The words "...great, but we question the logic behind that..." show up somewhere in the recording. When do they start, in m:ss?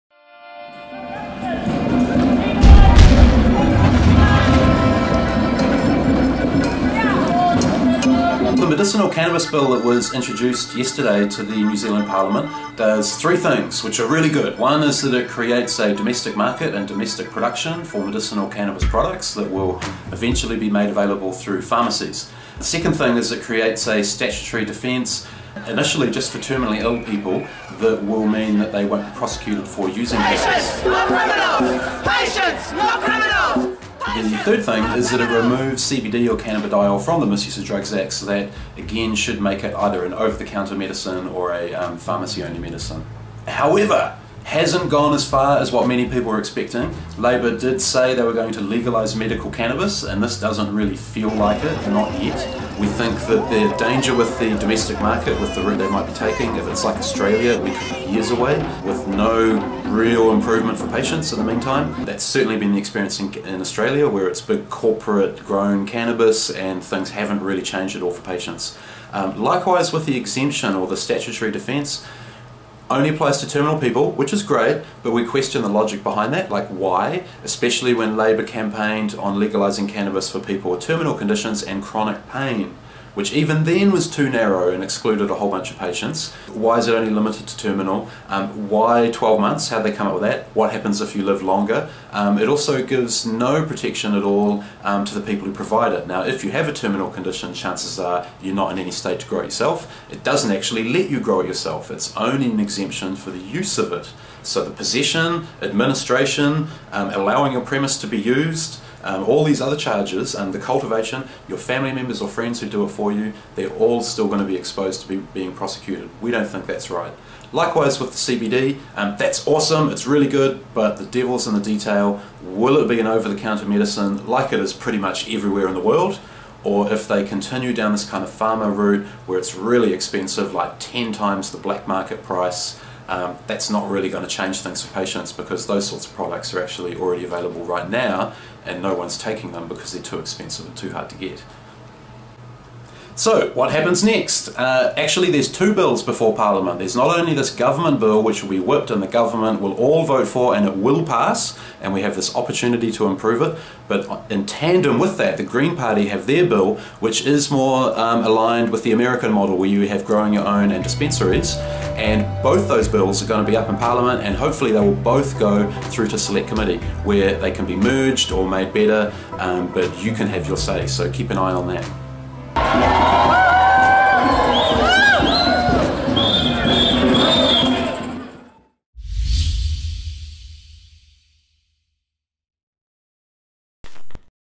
1:14.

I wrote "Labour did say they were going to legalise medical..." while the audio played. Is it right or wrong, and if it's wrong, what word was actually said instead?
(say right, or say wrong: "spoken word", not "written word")
right.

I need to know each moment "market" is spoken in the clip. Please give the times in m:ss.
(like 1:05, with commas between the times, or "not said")
0:16, 0:54, 2:11.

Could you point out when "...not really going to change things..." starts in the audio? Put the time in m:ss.
2:13.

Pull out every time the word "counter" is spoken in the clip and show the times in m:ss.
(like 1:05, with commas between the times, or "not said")
0:40, 2:03.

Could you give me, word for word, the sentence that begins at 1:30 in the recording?
What happens if you live longer?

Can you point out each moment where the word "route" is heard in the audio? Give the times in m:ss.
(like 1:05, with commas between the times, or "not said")
0:55, 2:08.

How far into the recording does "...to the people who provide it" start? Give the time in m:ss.
1:35.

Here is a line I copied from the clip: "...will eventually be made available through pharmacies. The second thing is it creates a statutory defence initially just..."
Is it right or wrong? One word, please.
right.